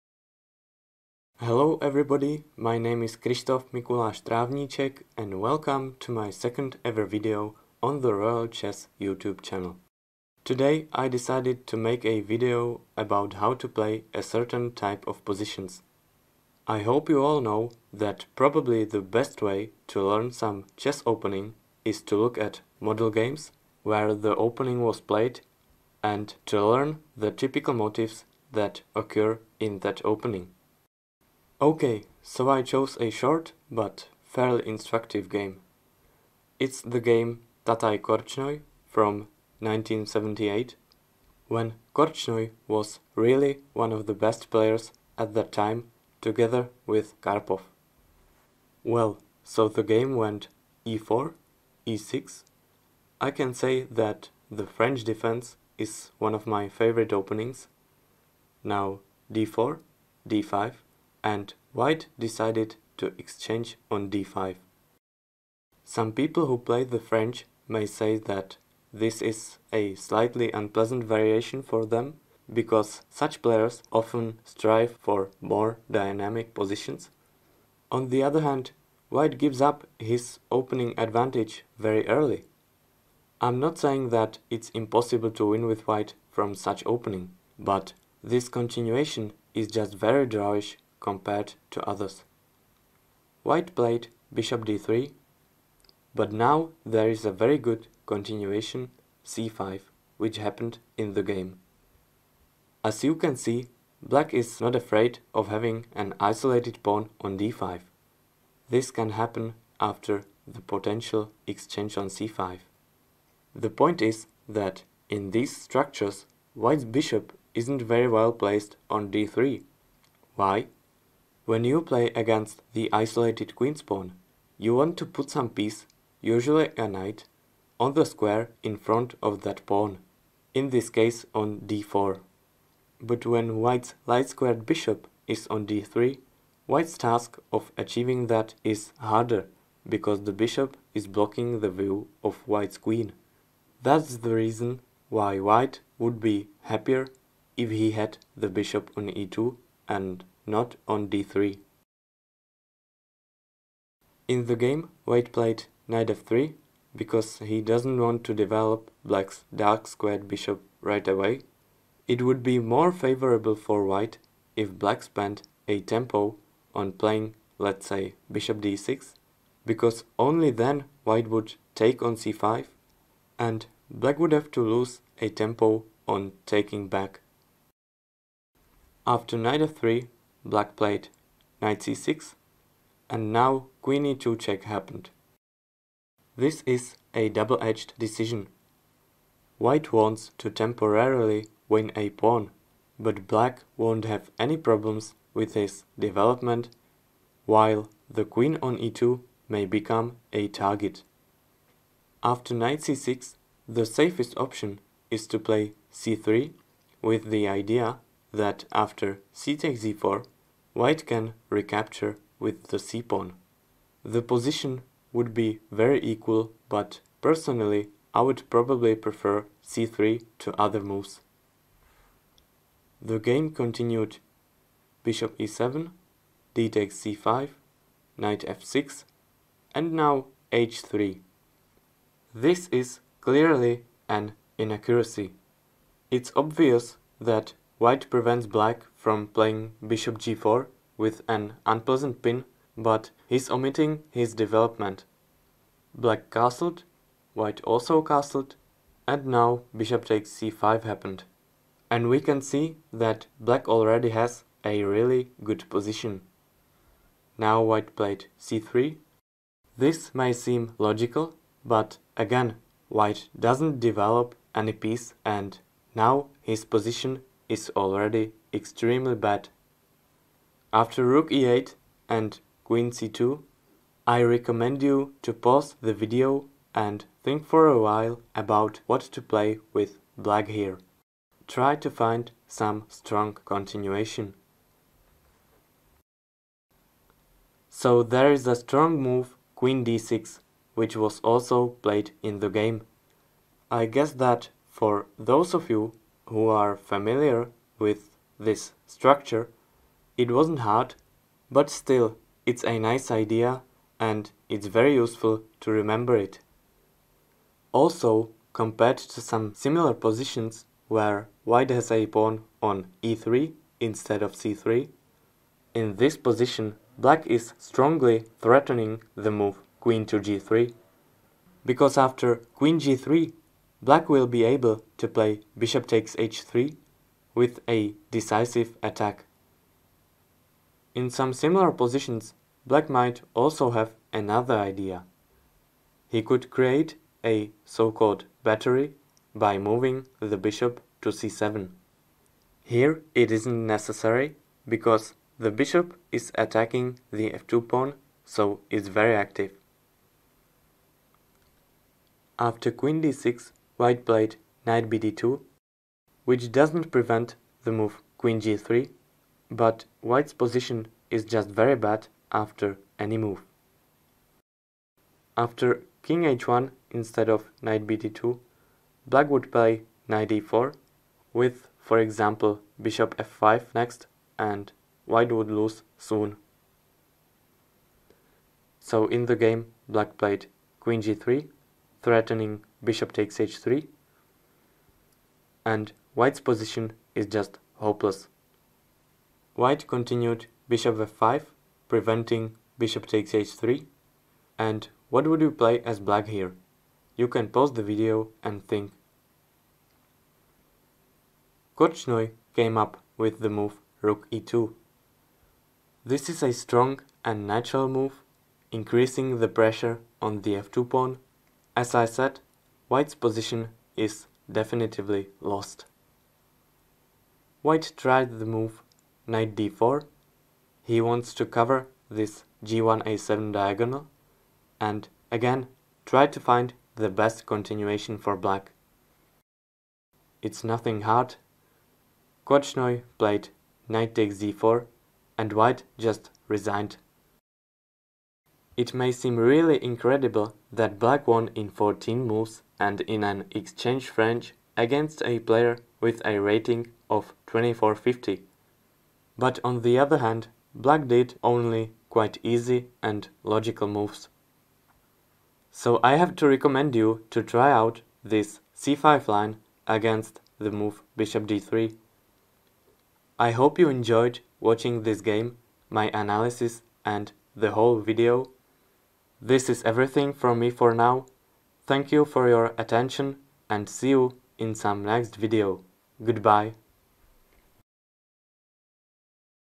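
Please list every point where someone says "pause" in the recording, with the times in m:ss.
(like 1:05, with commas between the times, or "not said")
4:35, 6:37.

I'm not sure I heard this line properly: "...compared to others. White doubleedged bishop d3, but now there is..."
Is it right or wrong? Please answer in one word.
wrong.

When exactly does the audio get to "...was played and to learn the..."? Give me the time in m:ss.
0:24.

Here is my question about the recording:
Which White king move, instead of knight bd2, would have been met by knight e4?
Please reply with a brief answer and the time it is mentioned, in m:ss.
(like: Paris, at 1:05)
king h1, at 6:06.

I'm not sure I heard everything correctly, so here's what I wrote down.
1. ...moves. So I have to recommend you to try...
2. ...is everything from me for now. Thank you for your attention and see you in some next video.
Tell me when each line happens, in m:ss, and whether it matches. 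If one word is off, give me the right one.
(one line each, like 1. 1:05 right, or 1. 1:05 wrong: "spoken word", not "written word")
1. 7:33 right
2. 7:49 right.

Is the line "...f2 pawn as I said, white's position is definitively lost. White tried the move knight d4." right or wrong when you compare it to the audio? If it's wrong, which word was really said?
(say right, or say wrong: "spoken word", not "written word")
right.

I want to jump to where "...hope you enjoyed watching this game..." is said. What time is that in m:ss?
7:43.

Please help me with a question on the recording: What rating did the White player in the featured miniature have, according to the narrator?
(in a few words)
2450.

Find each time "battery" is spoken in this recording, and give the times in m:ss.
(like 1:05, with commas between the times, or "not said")
5:38.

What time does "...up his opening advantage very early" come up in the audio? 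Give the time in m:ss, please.
1:19.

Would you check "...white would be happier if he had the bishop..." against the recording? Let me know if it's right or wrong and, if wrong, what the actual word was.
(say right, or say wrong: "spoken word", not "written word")
right.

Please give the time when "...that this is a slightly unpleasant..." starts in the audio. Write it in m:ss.
1:08.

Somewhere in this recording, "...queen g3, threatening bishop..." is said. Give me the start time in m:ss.
6:20.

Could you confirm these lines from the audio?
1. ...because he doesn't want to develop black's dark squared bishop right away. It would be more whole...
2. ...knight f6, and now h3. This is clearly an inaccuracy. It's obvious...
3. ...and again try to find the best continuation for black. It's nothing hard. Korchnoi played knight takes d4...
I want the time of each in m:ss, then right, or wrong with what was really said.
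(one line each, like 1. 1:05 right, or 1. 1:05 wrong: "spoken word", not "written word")
1. 2:37 wrong: "favorable", not "whole"
2. 3:48 right
3. 7:04 right.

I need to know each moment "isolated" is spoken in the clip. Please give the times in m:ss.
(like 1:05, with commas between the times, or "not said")
1:46, 2:02.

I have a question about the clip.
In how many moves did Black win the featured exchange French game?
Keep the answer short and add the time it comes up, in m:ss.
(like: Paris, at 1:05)
14, at 7:21.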